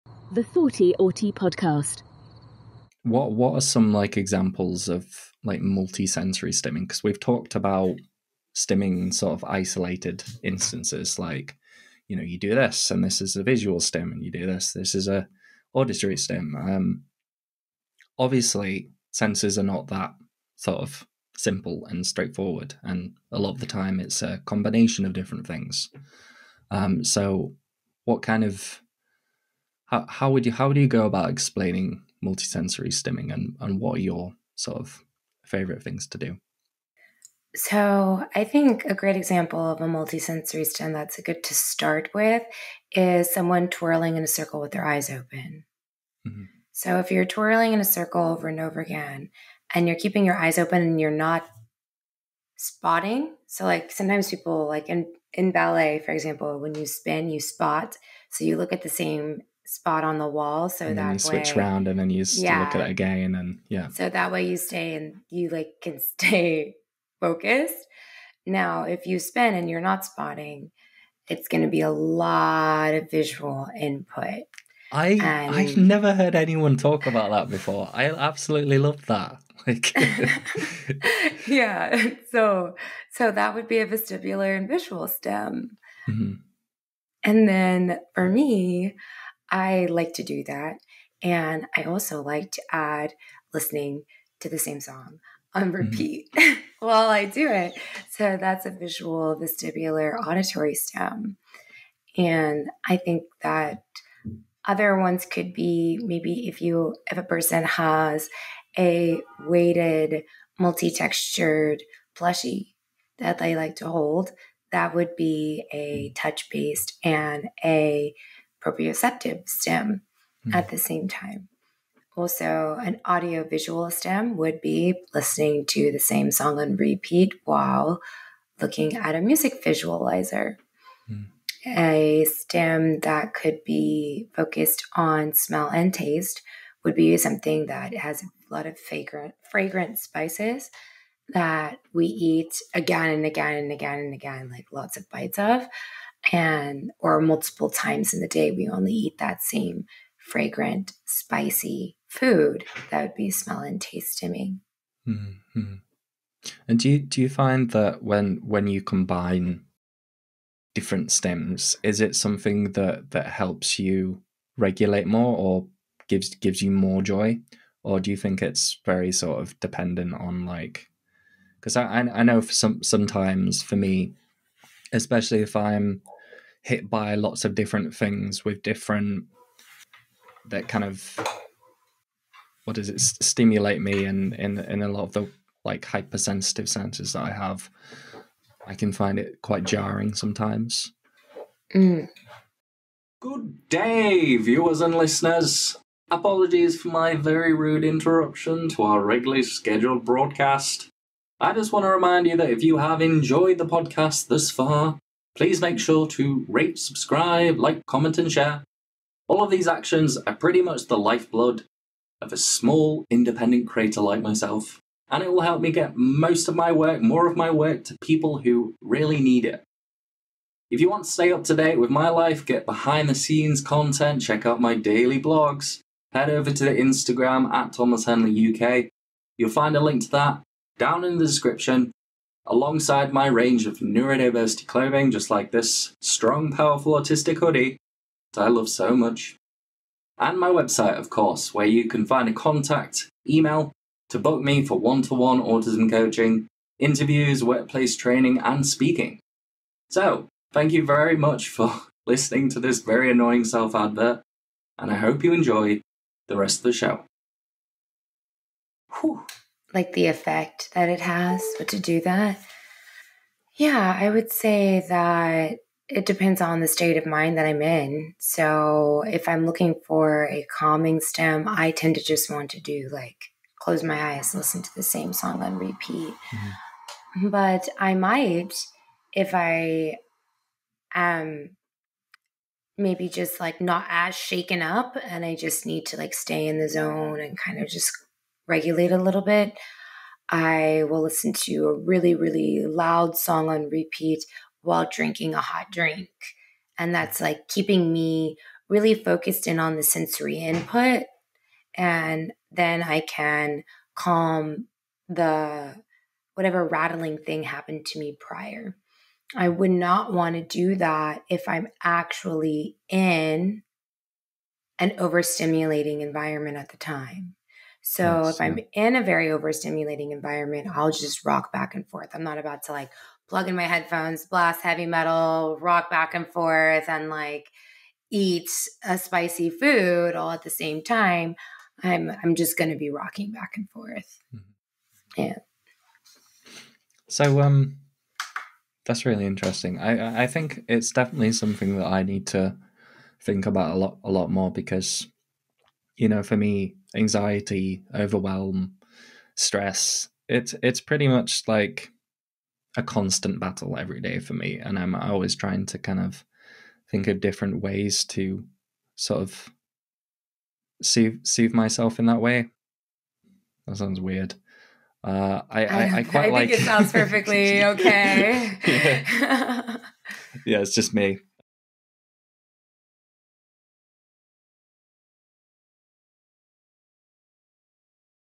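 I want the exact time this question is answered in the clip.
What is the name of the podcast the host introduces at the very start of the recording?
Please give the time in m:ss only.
0:00.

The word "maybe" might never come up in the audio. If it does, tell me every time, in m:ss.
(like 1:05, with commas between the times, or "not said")
1:46, 4:42.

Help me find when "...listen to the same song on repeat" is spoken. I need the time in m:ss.
4:34.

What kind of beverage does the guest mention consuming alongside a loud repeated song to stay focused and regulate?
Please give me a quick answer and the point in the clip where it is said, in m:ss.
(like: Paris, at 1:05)
A hot drink, at 4:55.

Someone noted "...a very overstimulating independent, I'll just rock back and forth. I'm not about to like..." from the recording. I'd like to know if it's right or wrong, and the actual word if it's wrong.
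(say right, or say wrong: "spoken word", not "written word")
wrong: "environment", not "independent".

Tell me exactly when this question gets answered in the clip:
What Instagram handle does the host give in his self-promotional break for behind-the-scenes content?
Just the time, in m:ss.
3:47.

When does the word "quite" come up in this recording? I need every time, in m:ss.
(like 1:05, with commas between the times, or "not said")
3:09, 6:06.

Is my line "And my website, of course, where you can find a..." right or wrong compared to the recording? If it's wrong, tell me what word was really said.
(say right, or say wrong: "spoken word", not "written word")
right.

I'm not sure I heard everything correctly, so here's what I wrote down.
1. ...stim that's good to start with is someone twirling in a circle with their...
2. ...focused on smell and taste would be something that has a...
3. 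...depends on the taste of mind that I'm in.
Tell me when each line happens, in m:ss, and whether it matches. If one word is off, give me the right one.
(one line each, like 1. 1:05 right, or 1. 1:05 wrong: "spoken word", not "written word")
1. 0:40 right
2. 2:14 right
3. 4:26 wrong: "state", not "taste".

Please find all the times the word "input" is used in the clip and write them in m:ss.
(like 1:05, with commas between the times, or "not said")
1:13, 5:00.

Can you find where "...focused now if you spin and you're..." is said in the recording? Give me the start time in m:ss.
1:07.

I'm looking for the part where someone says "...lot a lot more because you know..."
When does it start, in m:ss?
5:43.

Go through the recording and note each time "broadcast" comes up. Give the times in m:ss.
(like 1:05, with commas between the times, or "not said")
3:20.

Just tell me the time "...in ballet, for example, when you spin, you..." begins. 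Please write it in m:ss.
0:55.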